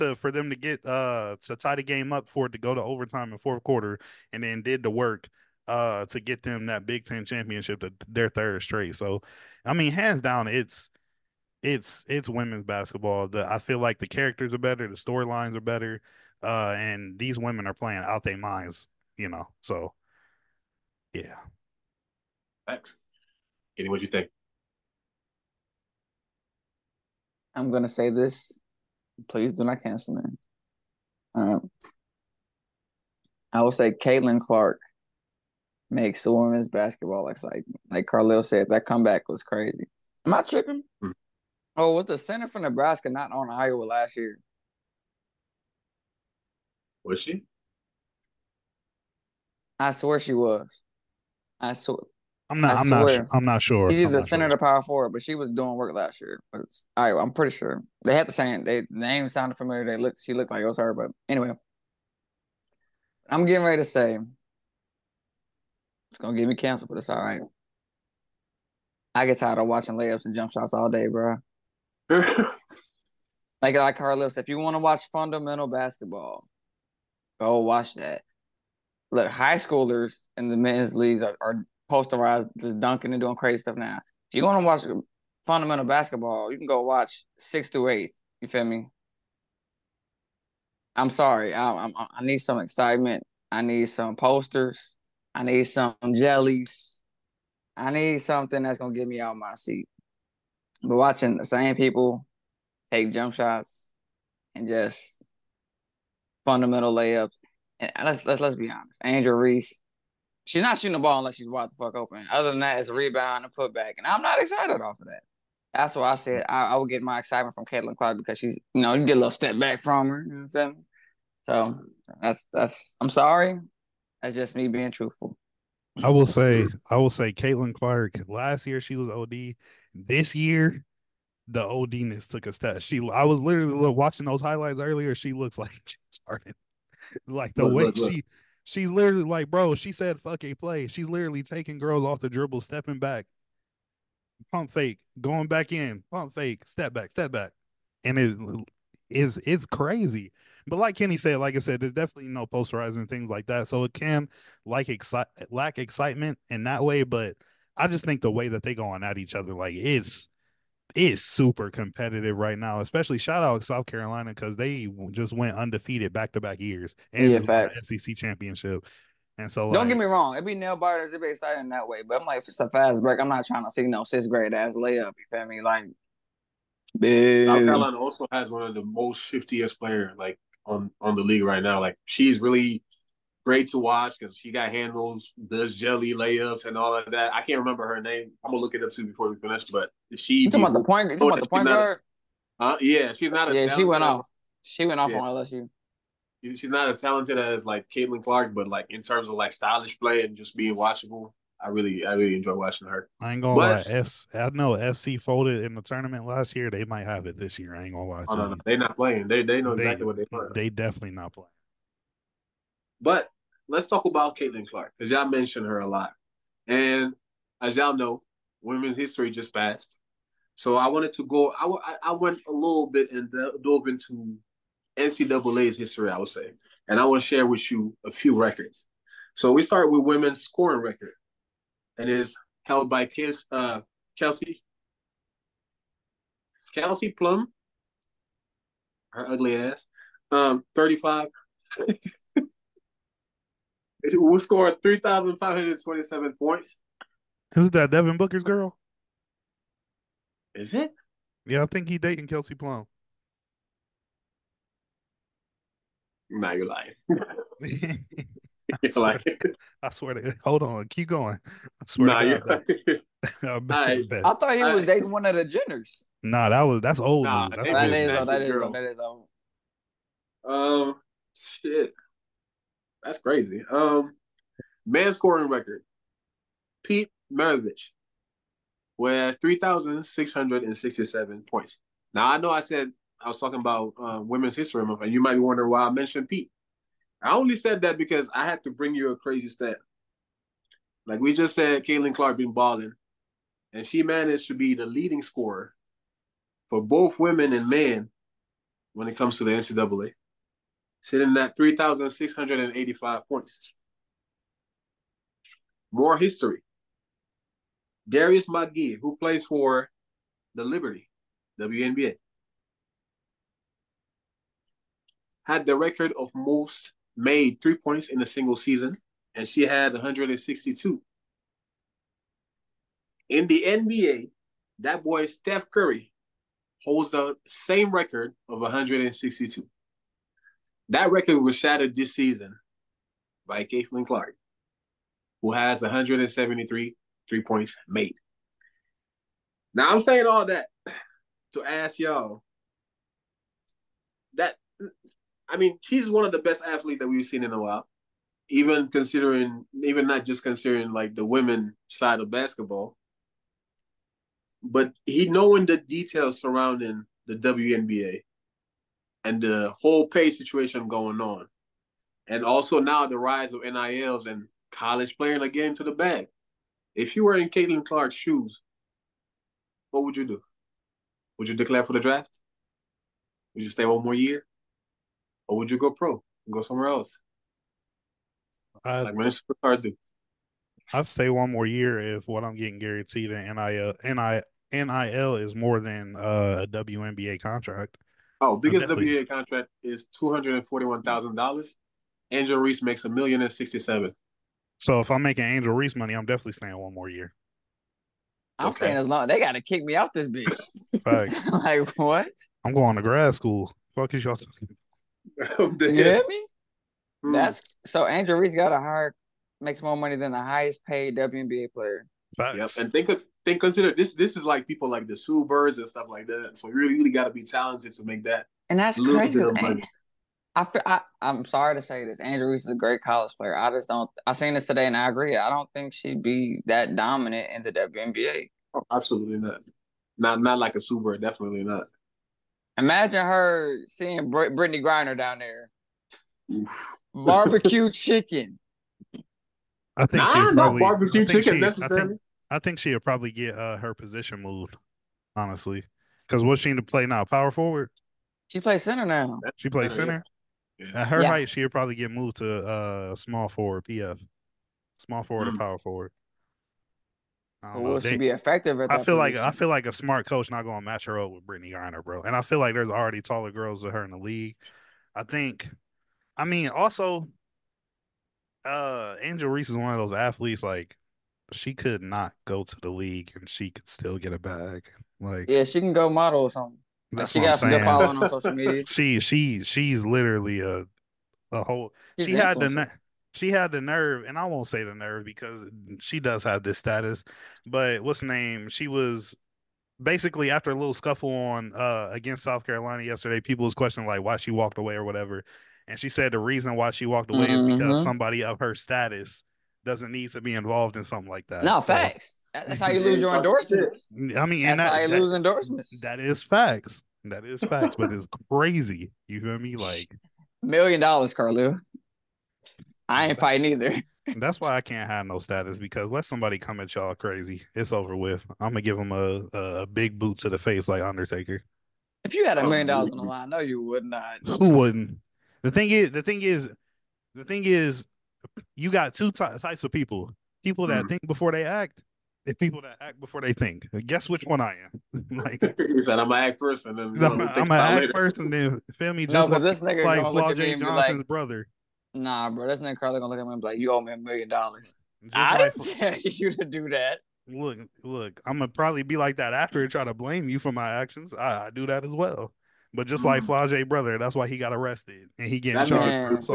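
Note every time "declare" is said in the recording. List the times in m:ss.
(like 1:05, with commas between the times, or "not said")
6:11.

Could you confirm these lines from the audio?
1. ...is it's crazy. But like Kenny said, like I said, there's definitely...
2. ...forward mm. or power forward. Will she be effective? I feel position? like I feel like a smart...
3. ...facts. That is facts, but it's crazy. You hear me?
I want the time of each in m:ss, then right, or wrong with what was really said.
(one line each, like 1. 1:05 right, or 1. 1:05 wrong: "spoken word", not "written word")
1. 2:29 right
2. 7:35 right
3. 8:26 right.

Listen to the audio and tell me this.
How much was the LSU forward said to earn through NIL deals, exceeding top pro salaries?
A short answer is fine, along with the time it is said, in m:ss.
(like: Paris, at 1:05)
$1,067,000, at 6:33.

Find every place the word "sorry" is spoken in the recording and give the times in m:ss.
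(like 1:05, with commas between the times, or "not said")
1:31, 2:03, 7:01.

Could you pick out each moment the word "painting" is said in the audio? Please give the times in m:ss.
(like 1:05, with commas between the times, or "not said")
not said.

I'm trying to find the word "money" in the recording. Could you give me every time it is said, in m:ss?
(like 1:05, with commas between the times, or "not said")
6:35, 6:49.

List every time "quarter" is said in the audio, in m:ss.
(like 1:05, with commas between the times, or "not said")
0:03.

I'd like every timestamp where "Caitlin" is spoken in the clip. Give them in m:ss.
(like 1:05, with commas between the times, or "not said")
0:33, 1:57, 2:07, 3:17, 3:34, 4:51, 5:33, 6:07.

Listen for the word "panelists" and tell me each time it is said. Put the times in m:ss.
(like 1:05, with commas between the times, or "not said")
not said.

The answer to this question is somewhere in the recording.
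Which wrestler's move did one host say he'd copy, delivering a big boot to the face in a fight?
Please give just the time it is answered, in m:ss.
8:41.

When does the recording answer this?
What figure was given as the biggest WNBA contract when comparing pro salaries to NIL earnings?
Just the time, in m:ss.
6:30.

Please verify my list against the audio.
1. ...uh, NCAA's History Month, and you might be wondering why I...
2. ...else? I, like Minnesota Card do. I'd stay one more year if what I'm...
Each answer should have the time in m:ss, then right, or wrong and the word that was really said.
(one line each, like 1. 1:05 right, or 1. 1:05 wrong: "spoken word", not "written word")
1. 4:44 wrong: "Women", not "NCAA"
2. 6:16 right.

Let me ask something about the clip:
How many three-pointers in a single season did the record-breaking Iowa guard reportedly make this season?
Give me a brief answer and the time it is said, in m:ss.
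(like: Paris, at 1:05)
173, at 5:35.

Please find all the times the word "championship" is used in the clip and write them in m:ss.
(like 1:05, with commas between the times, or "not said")
0:07, 2:48.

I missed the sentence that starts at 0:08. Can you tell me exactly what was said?
So I mean hands down it's it's it's women's basketball.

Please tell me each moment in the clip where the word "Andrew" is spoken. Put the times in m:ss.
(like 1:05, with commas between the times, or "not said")
1:49, 7:02.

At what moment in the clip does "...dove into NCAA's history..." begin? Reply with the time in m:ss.
3:43.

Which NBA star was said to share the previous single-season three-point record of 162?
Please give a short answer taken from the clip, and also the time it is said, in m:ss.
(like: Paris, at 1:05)
Steph Curry, at 5:25.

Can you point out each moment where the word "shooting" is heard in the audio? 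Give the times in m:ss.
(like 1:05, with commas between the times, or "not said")
1:50.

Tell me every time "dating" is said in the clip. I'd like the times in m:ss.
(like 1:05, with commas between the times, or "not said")
4:11, 4:24.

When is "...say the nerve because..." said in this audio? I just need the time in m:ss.
8:04.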